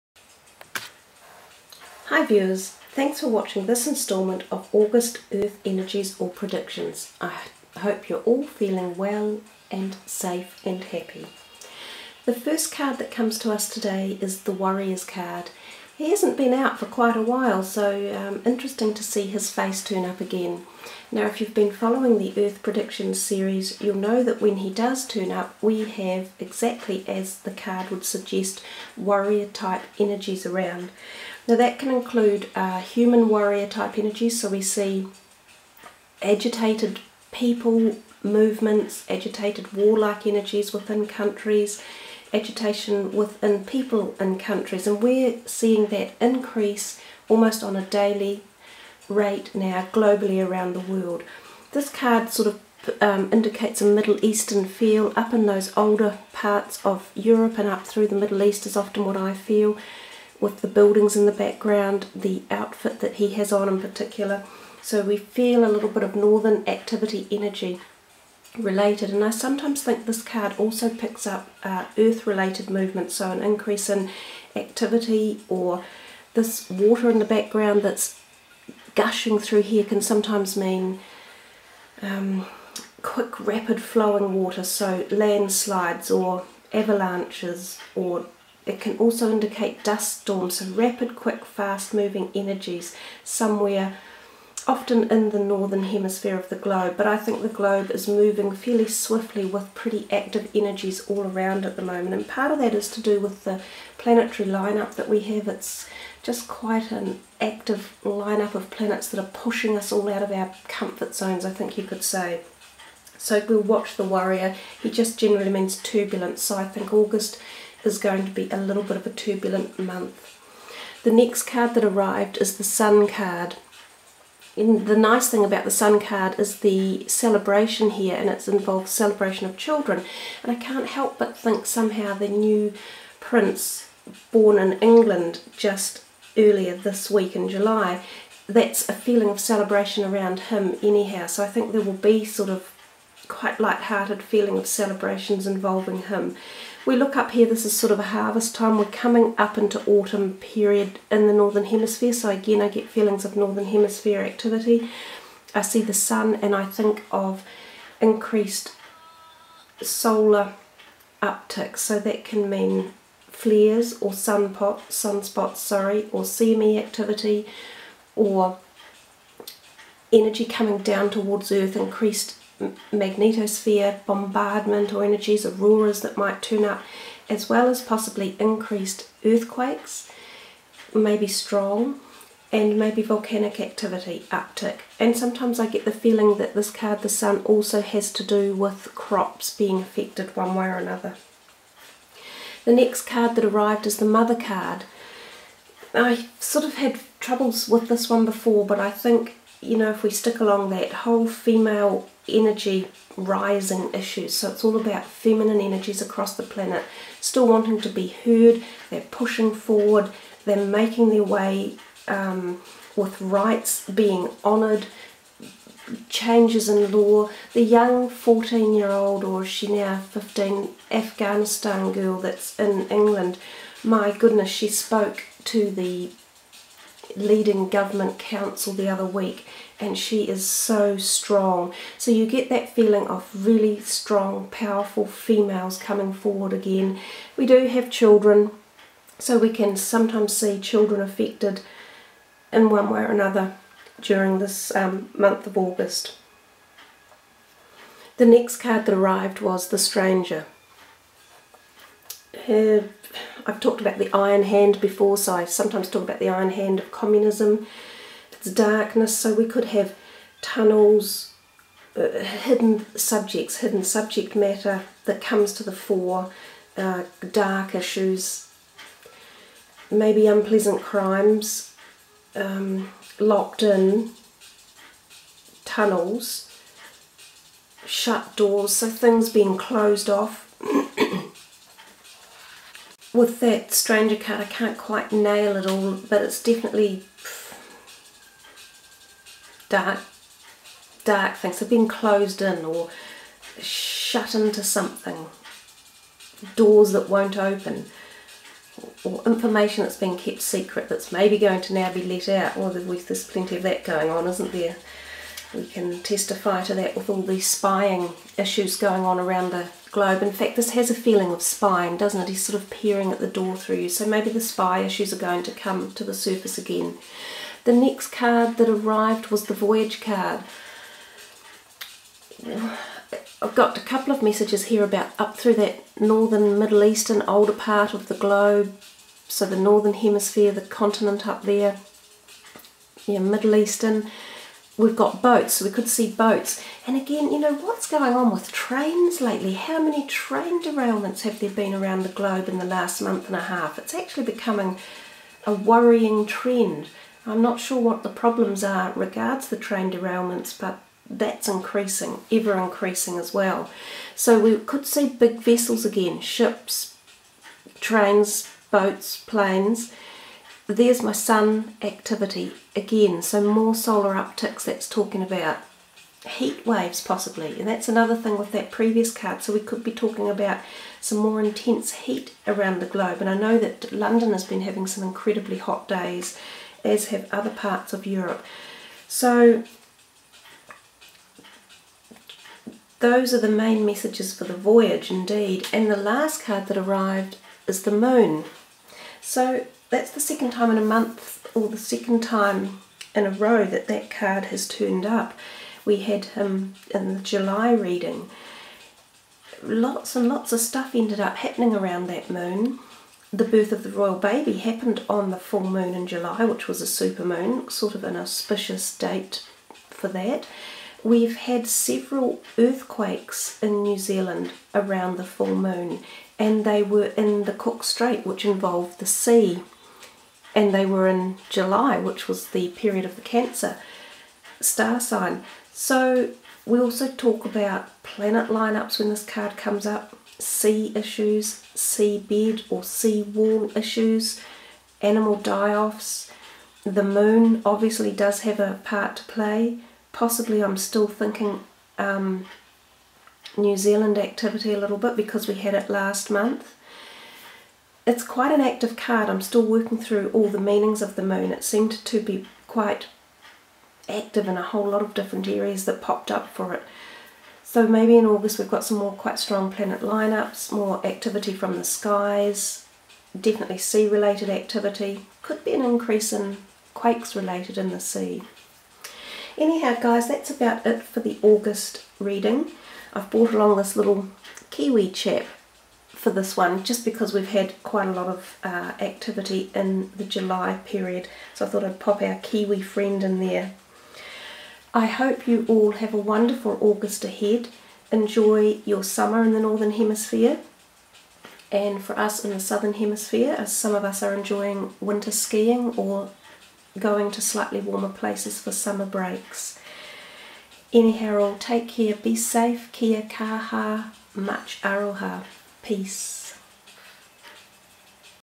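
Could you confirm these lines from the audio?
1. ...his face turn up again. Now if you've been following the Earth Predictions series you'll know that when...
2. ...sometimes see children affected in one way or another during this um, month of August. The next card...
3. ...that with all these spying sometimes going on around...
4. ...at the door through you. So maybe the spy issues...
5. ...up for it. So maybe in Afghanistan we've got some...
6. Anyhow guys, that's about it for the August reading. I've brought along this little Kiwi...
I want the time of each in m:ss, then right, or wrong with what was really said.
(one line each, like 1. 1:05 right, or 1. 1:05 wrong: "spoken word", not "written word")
1. 0:19 right
2. 3:59 right
3. 5:06 wrong: "issues", not "sometimes"
4. 5:13 right
5. 7:36 wrong: "August", not "Afghanistan"
6. 7:49 right.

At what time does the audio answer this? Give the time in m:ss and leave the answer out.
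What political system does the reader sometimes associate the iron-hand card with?
4:16.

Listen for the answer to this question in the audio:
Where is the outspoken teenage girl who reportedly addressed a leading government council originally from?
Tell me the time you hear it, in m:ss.
3:40.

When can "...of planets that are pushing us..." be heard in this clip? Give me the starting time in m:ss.
1:48.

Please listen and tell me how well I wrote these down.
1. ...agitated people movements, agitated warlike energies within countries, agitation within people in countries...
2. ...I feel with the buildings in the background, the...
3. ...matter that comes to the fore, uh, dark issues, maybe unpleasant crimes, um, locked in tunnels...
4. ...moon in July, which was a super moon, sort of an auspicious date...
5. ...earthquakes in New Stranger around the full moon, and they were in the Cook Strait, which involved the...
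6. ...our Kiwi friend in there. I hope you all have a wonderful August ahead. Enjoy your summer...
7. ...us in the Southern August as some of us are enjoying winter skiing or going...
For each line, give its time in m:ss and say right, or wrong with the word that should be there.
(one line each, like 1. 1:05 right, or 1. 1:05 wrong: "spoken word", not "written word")
1. 0:36 right
2. 0:59 right
3. 4:24 right
4. 6:45 right
5. 6:52 wrong: "Zealand", not "Stranger"
6. 8:02 right
7. 8:12 wrong: "Hemisphere", not "August".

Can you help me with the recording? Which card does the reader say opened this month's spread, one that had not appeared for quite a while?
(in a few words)
Warriors card.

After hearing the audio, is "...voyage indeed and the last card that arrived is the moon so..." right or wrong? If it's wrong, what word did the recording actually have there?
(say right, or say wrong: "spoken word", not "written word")
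right.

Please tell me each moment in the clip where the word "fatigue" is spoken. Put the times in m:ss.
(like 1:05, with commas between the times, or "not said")
not said.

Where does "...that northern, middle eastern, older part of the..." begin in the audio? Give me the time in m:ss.
5:25.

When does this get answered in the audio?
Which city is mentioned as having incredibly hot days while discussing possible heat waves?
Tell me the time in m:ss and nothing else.
6:13.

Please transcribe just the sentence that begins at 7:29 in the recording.
I'm still working through all the meanings of the moon.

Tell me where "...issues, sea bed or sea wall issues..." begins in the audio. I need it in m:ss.
7:10.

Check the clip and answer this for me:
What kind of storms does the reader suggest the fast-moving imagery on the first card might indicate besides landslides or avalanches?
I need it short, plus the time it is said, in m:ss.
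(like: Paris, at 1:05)
dust storms, at 1:29.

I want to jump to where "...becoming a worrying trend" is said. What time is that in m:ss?
5:44.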